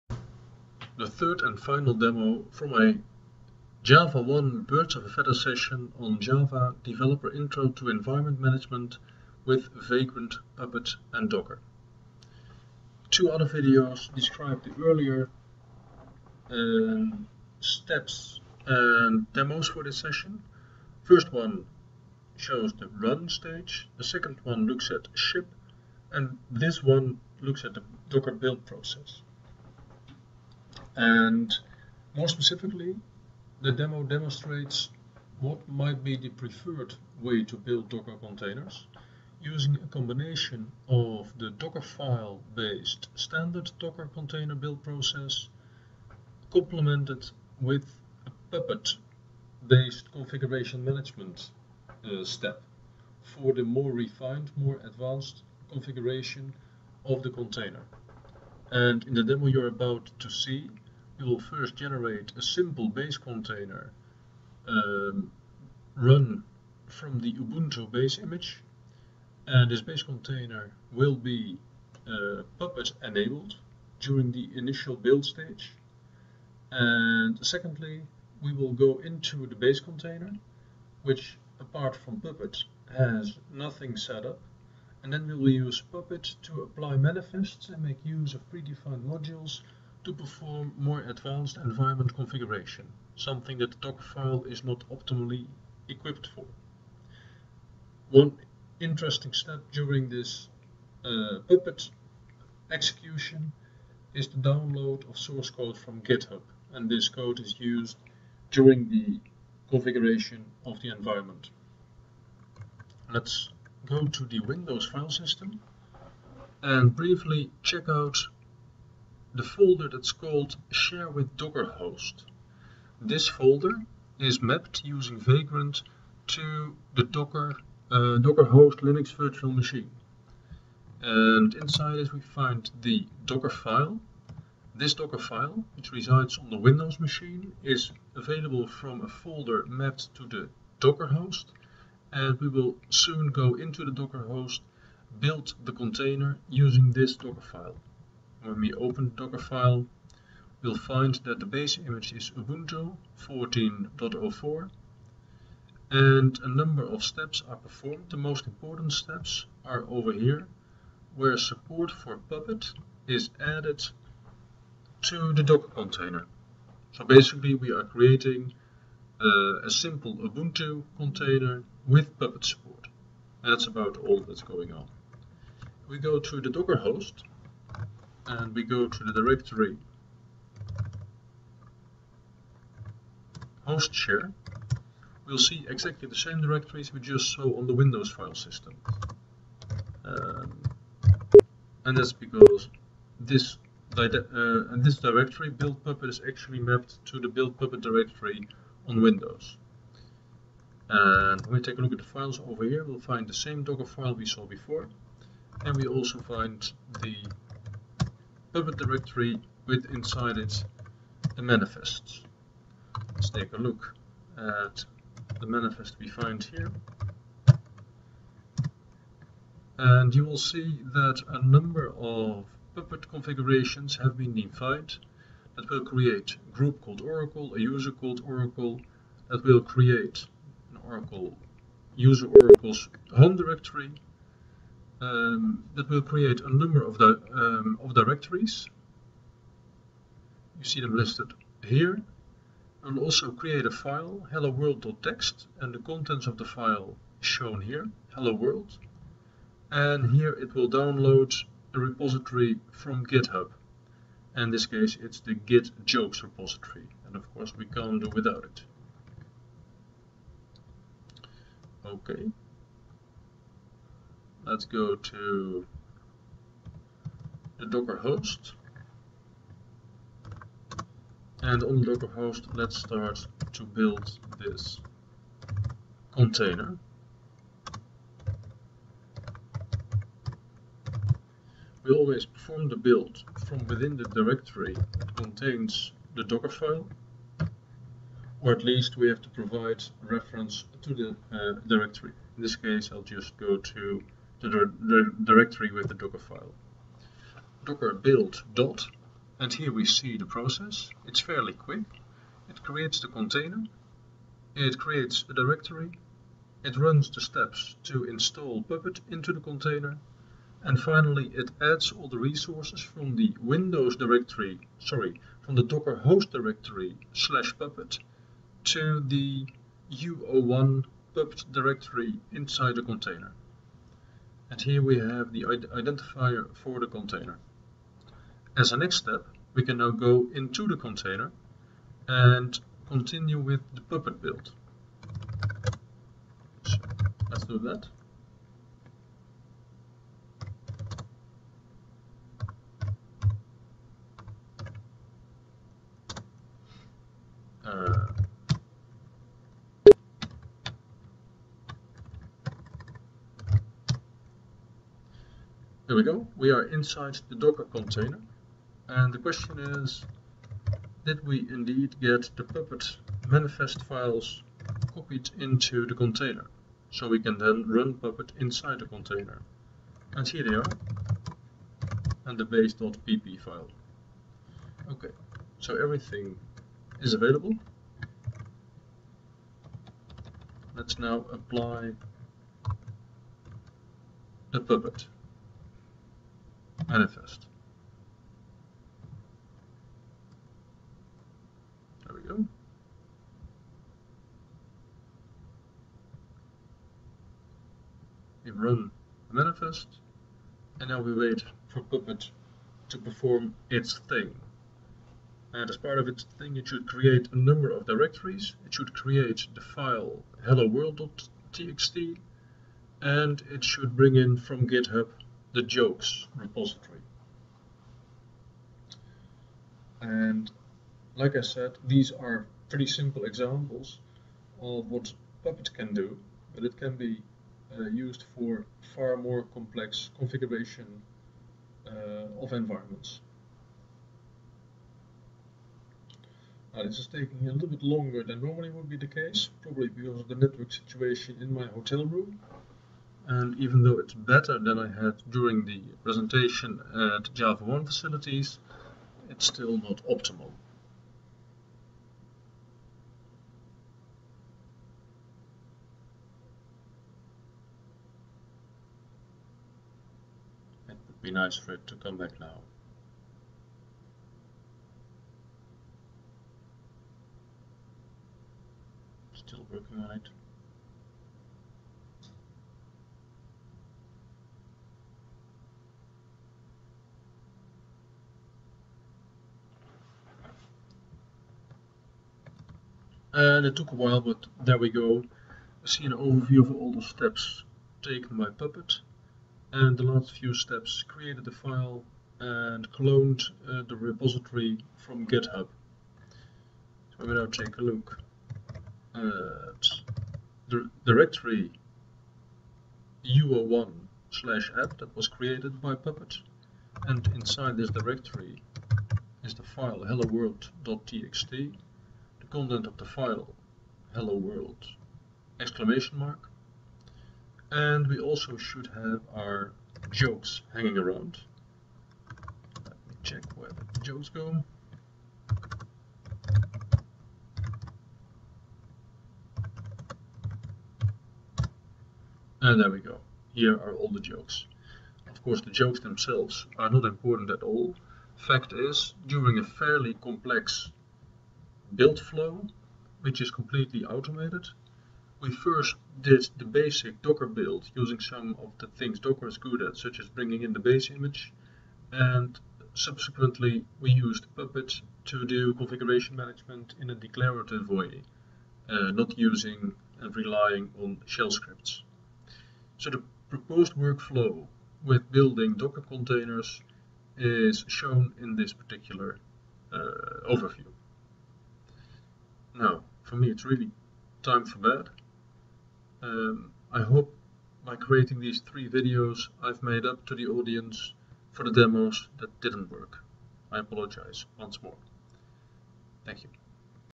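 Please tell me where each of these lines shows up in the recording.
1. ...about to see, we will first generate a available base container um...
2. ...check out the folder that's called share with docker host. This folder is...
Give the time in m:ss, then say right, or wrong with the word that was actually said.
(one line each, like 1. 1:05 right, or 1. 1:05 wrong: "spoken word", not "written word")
1. 0:59 wrong: "simple", not "available"
2. 1:57 right.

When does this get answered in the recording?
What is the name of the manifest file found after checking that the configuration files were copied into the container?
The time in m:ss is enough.
6:12.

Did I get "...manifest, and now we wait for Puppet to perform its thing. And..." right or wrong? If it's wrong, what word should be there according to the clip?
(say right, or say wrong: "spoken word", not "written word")
right.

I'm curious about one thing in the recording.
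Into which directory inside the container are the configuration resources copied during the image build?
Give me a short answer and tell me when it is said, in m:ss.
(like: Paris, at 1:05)
u01 puppet, at 5:19.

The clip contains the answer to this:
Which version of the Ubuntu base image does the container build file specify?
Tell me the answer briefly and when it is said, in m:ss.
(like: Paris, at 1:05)
14.04, at 2:32.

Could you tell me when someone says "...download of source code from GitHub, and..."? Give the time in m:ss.
1:44.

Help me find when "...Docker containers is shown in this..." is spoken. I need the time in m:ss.
9:25.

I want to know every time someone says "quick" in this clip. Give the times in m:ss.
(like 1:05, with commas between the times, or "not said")
5:01.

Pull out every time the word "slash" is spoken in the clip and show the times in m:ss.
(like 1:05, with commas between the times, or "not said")
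5:17, 8:24.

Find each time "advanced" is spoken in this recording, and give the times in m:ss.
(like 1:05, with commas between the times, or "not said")
0:54, 1:31.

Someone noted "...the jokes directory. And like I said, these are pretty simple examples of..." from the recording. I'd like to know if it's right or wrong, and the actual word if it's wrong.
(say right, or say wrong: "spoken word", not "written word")
wrong: "repository", not "directory".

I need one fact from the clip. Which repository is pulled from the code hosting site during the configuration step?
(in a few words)
Git jokes.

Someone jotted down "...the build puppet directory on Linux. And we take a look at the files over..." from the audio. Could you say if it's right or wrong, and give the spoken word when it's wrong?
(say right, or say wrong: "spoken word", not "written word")
wrong: "Windows", not "Linux".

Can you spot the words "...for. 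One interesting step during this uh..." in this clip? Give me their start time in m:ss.
1:36.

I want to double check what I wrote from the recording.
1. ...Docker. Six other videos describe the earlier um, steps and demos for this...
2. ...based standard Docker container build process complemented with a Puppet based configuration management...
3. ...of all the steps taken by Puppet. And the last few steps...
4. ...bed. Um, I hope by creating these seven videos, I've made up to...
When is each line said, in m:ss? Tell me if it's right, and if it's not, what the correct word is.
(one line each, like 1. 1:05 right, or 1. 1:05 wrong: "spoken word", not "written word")
1. 0:11 wrong: "Two", not "Six"
2. 0:42 right
3. 8:06 right
4. 9:34 wrong: "three", not "seven".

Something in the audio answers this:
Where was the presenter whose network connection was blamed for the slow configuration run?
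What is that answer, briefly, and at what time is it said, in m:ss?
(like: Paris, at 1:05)
hotel room, at 7:21.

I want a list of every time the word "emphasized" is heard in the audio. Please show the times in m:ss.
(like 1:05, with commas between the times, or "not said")
not said.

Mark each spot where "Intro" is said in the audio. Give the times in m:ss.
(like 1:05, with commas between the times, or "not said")
0:07.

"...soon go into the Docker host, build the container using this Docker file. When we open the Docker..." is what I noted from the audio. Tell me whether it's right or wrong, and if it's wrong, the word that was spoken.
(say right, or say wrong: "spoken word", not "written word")
right.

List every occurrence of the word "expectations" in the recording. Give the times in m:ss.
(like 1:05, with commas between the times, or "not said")
not said.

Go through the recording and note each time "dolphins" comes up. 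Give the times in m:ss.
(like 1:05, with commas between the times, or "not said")
not said.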